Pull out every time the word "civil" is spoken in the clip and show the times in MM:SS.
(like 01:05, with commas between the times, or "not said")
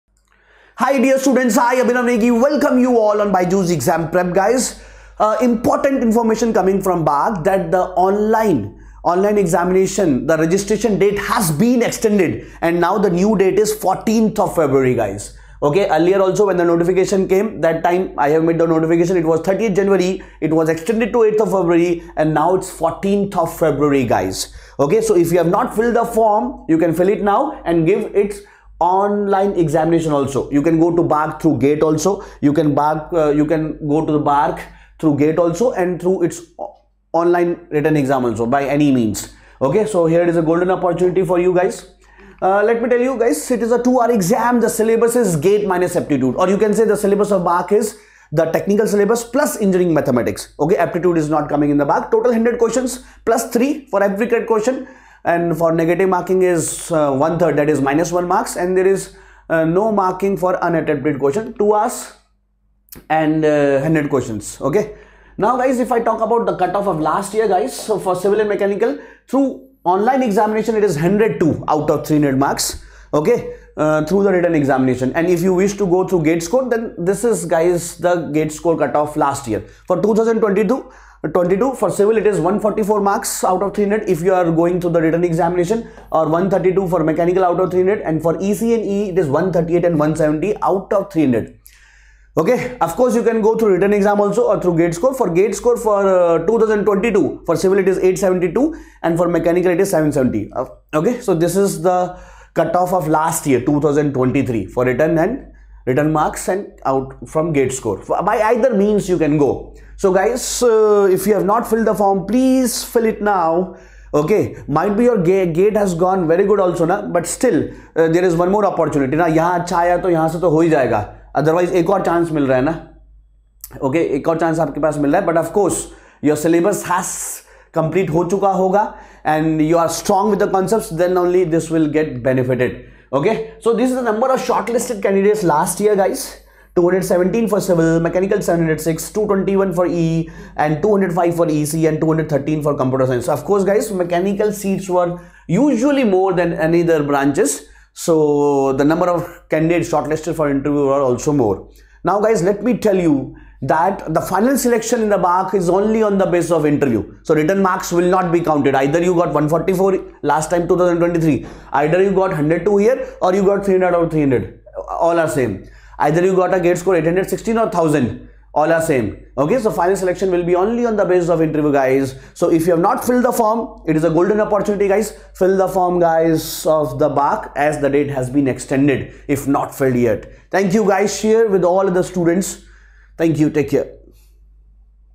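01:08, 01:21, 01:37, 02:17.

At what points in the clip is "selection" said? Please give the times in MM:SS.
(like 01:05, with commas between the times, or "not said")
02:34, 02:49.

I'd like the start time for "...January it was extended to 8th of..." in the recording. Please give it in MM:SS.
00:19.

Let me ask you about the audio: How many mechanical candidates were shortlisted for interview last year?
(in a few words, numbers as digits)
706.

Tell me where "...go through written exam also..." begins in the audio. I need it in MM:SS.
01:33.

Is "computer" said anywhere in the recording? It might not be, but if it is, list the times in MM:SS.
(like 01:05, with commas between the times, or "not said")
02:22.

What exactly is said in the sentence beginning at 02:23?
So, of course, guys, mechanical seats were usually more than any other branches.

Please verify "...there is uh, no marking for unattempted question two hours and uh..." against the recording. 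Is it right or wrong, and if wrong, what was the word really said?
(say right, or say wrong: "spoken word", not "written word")
right.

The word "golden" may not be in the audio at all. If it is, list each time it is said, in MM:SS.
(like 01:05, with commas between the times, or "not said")
00:40, 02:54.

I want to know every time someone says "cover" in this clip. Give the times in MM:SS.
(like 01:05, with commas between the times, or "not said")
not said.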